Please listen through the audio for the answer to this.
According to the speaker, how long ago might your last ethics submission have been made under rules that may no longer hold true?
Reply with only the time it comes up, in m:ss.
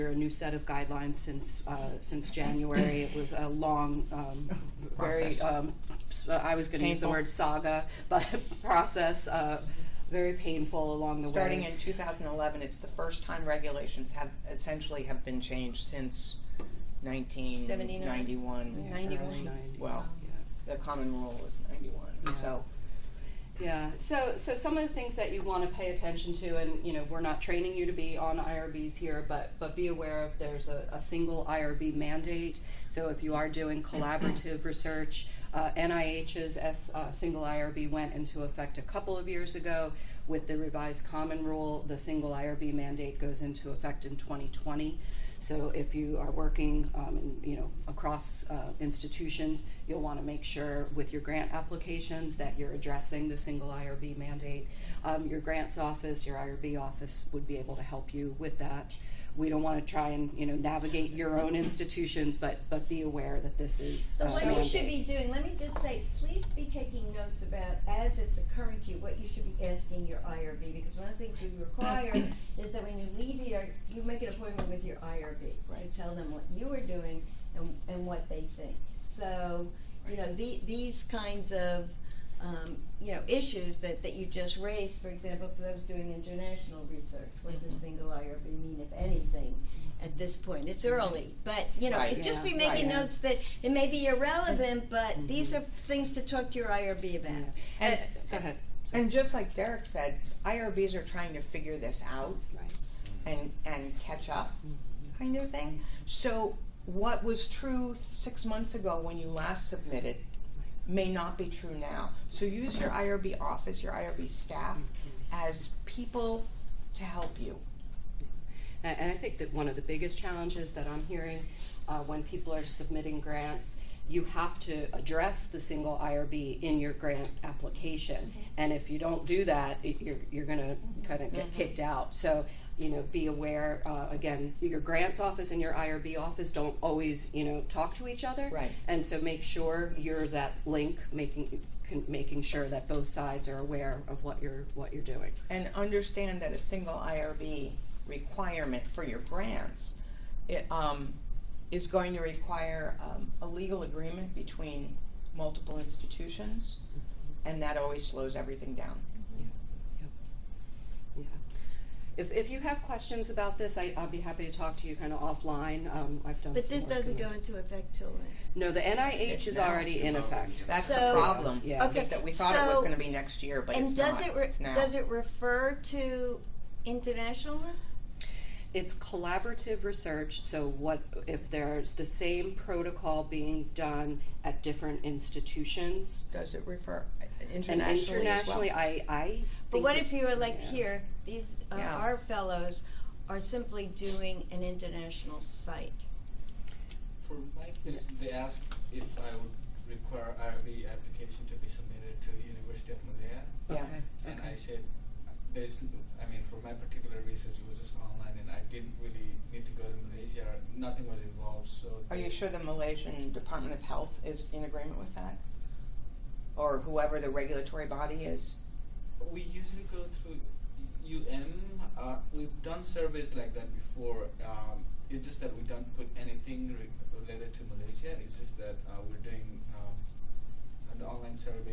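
1:47.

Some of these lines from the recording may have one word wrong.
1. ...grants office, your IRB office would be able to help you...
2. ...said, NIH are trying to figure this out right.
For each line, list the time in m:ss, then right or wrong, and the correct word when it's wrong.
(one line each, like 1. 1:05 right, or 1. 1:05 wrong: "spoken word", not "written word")
1. 0:55 right
2. 1:39 wrong: "IRBs", not "NIH".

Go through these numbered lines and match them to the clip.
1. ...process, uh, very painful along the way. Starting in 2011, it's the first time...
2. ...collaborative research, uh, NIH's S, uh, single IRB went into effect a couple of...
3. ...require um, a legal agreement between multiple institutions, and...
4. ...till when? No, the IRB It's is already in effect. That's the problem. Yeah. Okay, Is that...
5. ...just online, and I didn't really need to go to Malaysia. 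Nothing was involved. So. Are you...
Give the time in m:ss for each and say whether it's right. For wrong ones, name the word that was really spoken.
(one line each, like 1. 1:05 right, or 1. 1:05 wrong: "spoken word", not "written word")
1. 0:08 right
2. 0:33 right
3. 2:32 right
4. 2:47 wrong: "NIH", not "IRB"
5. 3:27 right.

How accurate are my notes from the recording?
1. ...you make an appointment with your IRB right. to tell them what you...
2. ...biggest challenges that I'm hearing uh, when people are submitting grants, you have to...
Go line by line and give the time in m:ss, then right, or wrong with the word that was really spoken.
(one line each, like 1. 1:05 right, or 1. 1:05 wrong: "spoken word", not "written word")
1. 1:13 right
2. 1:59 right.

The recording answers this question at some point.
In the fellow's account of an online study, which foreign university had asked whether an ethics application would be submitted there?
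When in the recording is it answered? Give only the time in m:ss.
3:22.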